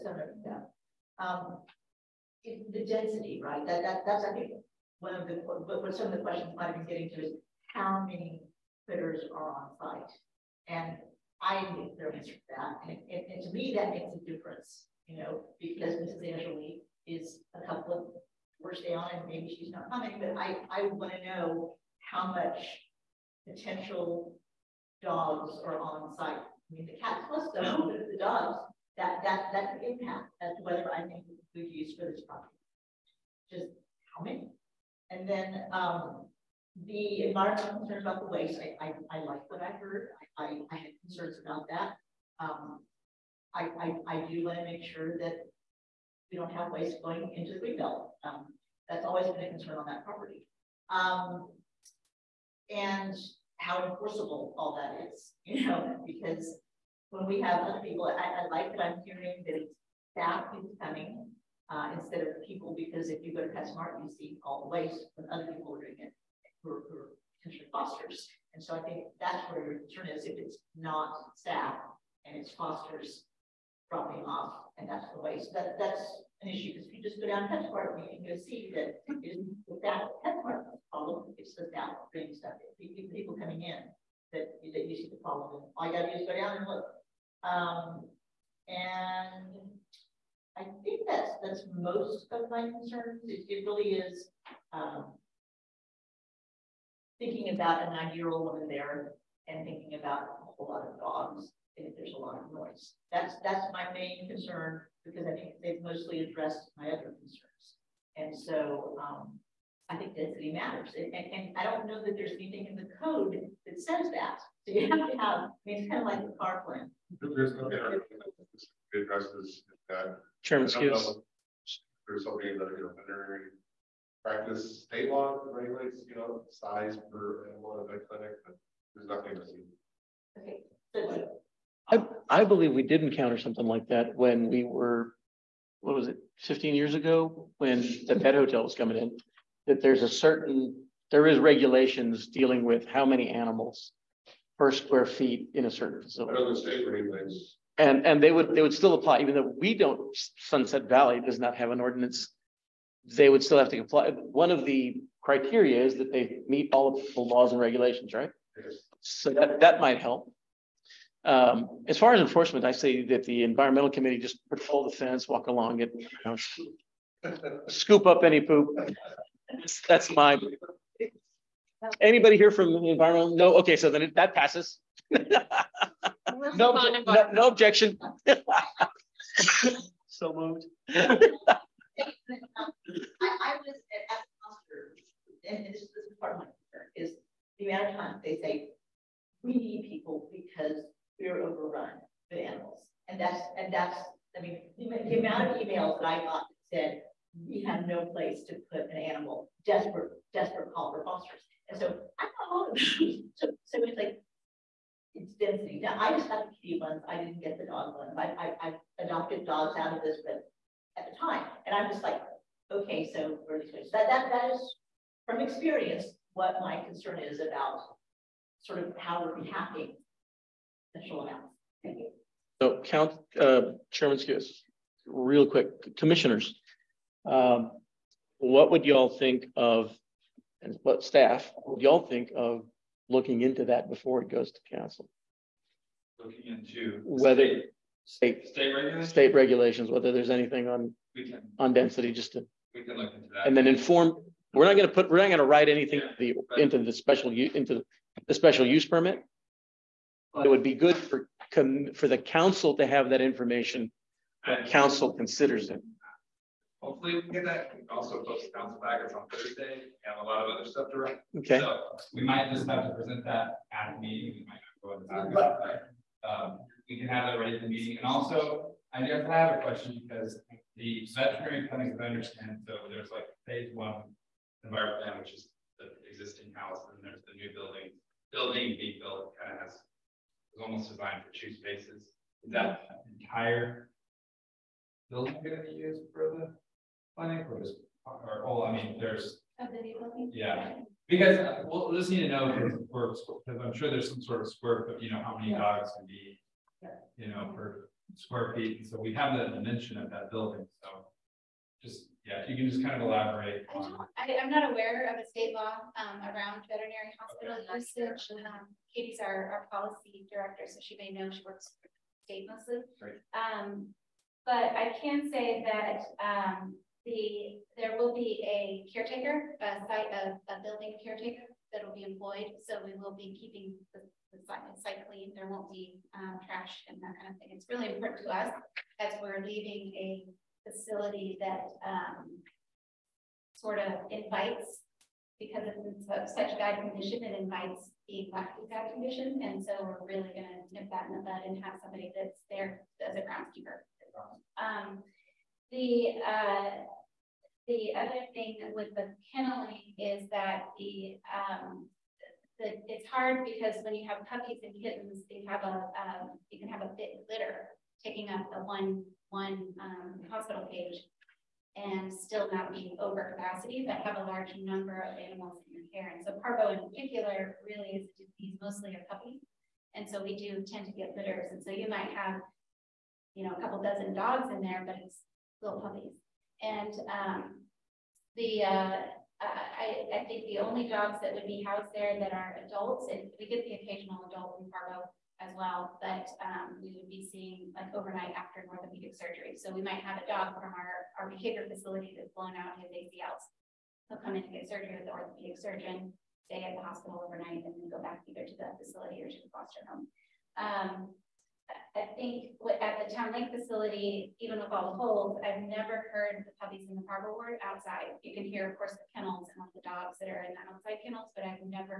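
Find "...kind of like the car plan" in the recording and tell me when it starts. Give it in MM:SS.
01:55.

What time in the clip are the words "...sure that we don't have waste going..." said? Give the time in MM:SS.
00:44.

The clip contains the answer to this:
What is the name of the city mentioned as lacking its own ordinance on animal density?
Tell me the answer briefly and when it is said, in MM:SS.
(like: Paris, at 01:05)
Sunset Valley, at 02:30.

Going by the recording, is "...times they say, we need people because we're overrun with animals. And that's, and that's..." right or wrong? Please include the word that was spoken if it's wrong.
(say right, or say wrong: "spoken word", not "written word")
right.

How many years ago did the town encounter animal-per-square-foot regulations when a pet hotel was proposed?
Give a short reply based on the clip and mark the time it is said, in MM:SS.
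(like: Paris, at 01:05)
15, at 02:16.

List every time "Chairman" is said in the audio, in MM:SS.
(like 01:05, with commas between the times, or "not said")
02:00, 03:43.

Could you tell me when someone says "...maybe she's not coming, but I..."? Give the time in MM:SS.
00:19.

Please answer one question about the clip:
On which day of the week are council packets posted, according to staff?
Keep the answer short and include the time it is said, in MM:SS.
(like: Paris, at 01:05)
Thursday, at 04:19.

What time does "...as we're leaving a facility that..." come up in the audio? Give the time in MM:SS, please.
05:28.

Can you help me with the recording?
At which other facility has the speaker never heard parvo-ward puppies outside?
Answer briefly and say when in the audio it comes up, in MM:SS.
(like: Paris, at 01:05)
Town Lake, at 06:43.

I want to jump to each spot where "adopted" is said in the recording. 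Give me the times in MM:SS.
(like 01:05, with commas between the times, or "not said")
03:29.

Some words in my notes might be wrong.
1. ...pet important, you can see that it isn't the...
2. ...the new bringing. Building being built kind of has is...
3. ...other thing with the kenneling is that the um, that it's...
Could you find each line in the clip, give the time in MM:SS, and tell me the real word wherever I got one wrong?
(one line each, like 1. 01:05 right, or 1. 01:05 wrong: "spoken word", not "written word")
1. 01:17 wrong: "department", not "important"
2. 04:37 wrong: "building", not "bringing"
3. 05:47 right.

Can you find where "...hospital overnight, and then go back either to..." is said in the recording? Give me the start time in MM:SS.
06:36.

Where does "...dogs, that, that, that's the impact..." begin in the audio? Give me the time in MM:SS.
00:28.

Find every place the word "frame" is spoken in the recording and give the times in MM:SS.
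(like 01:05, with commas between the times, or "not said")
not said.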